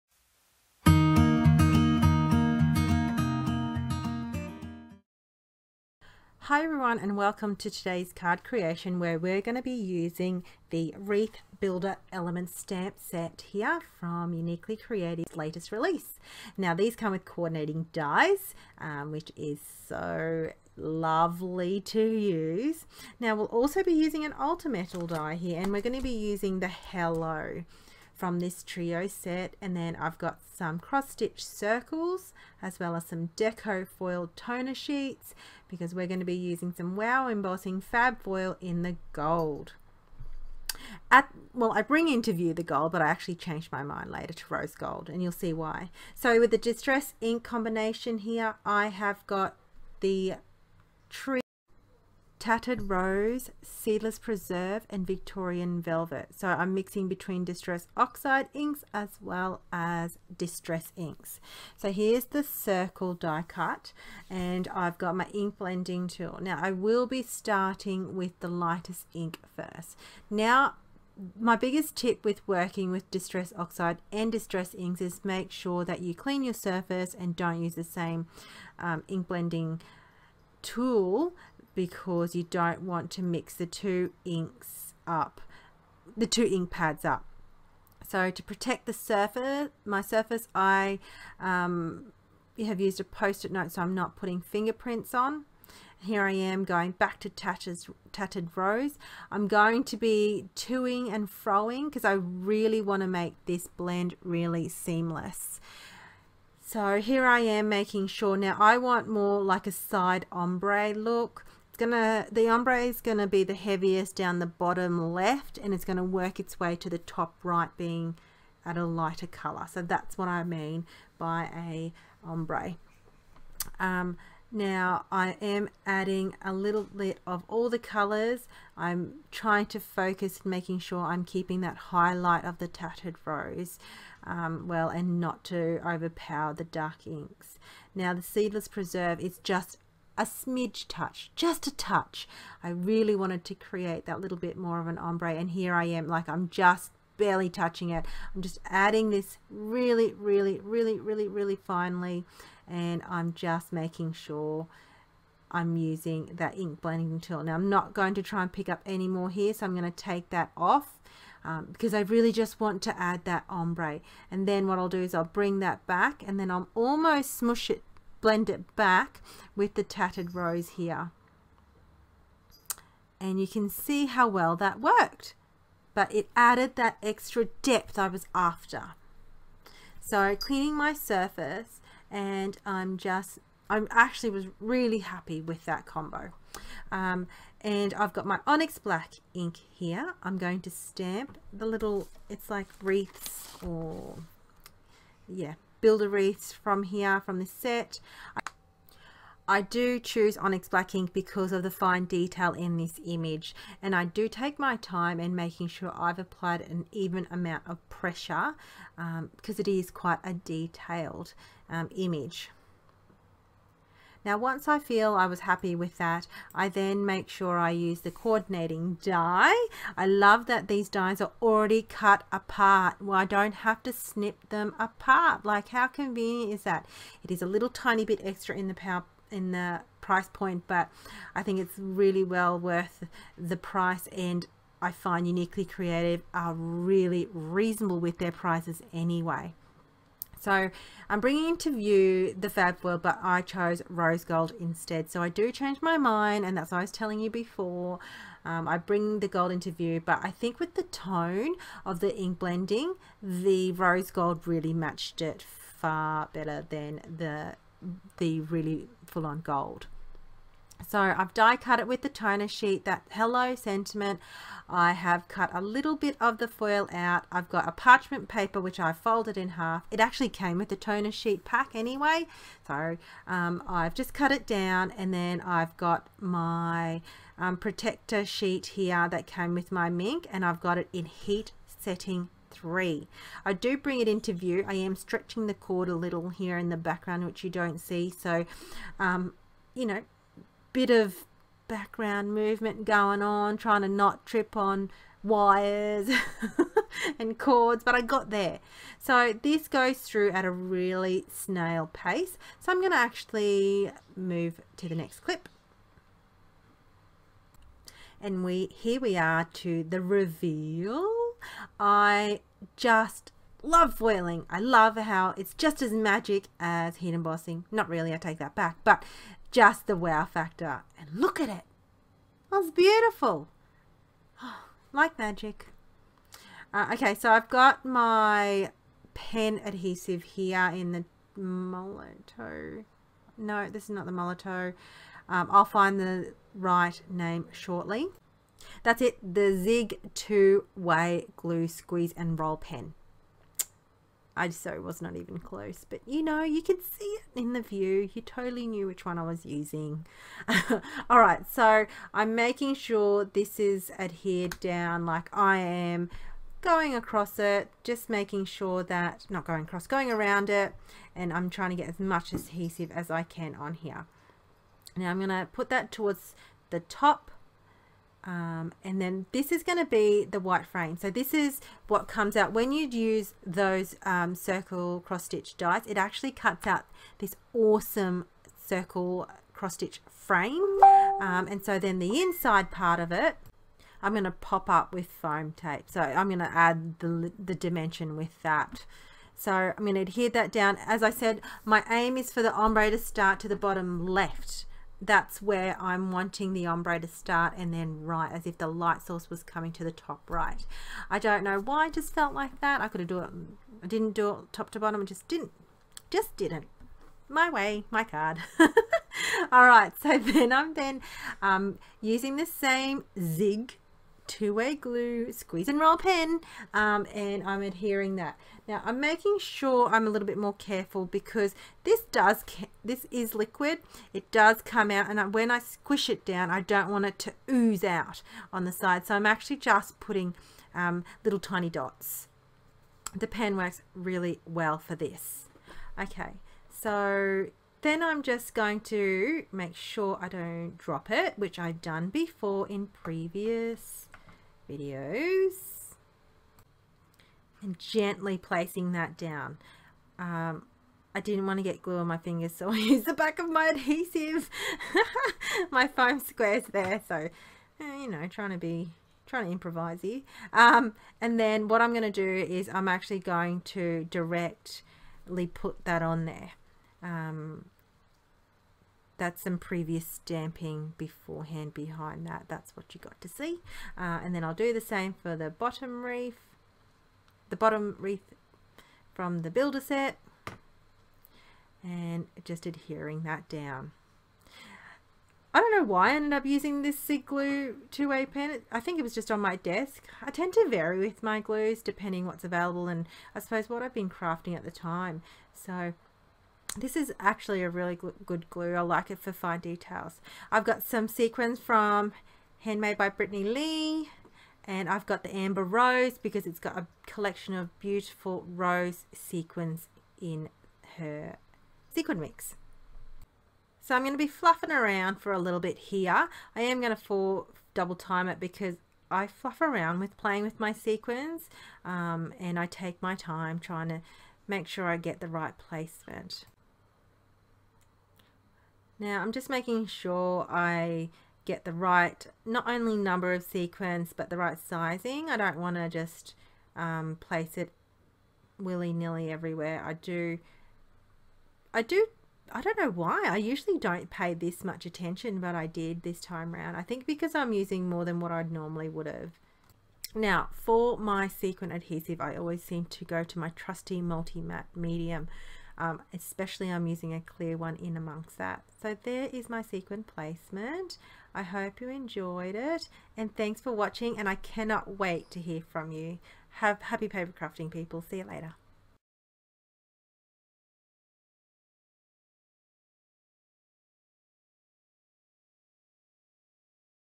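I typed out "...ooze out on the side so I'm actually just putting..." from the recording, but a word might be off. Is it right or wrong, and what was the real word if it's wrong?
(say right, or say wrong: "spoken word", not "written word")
right.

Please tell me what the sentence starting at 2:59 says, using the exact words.
So cleaning my surface and I'm just, I actually was really happy with that combo.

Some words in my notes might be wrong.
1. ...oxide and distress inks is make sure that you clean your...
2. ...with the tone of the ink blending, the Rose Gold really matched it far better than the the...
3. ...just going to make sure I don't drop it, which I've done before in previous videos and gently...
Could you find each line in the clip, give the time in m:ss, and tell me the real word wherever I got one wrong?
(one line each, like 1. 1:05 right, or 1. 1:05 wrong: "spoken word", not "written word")
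1. 1:13 right
2. 4:10 right
3. 7:18 right.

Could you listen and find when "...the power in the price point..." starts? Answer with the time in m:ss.
3:48.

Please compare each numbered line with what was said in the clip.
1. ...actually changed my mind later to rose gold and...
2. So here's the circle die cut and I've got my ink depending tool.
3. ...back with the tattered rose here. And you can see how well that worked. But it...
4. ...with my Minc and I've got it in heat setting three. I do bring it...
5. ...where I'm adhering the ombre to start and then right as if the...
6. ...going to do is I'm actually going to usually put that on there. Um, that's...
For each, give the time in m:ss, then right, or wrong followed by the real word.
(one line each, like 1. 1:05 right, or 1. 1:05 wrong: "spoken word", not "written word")
1. 0:43 right
2. 1:01 wrong: "blending", not "depending"
3. 2:48 right
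4. 4:39 right
5. 6:35 wrong: "wanting", not "adhering"
6. 7:41 wrong: "directly", not "usually".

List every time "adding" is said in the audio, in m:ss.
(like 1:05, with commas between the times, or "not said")
2:05, 2:28.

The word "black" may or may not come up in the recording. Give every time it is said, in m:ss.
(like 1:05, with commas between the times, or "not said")
3:08, 3:20.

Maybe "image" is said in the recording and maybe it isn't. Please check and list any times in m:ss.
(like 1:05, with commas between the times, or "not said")
3:23, 3:31.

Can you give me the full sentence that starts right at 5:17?
Not really, I take that back, but just the wow factor.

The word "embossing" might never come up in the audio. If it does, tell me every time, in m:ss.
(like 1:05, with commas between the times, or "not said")
0:37, 5:17.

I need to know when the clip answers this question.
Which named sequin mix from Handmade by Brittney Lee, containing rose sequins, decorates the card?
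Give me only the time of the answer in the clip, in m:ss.
8:25.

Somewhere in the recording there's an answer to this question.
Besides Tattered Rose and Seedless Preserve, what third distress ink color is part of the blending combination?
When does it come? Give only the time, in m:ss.
0:55.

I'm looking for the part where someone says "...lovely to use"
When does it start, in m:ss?
0:20.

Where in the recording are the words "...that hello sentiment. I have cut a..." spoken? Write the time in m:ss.
4:22.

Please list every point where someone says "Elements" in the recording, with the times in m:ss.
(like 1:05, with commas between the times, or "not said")
0:12.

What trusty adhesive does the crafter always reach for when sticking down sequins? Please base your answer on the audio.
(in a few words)
multi-matte medium.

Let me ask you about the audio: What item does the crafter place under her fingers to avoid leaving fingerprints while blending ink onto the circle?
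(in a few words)
Post-it note.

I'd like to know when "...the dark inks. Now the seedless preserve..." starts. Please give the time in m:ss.
2:16.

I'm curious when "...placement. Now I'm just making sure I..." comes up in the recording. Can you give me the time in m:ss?
8:45.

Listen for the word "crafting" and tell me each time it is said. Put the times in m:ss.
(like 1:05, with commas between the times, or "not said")
8:14, 9:27.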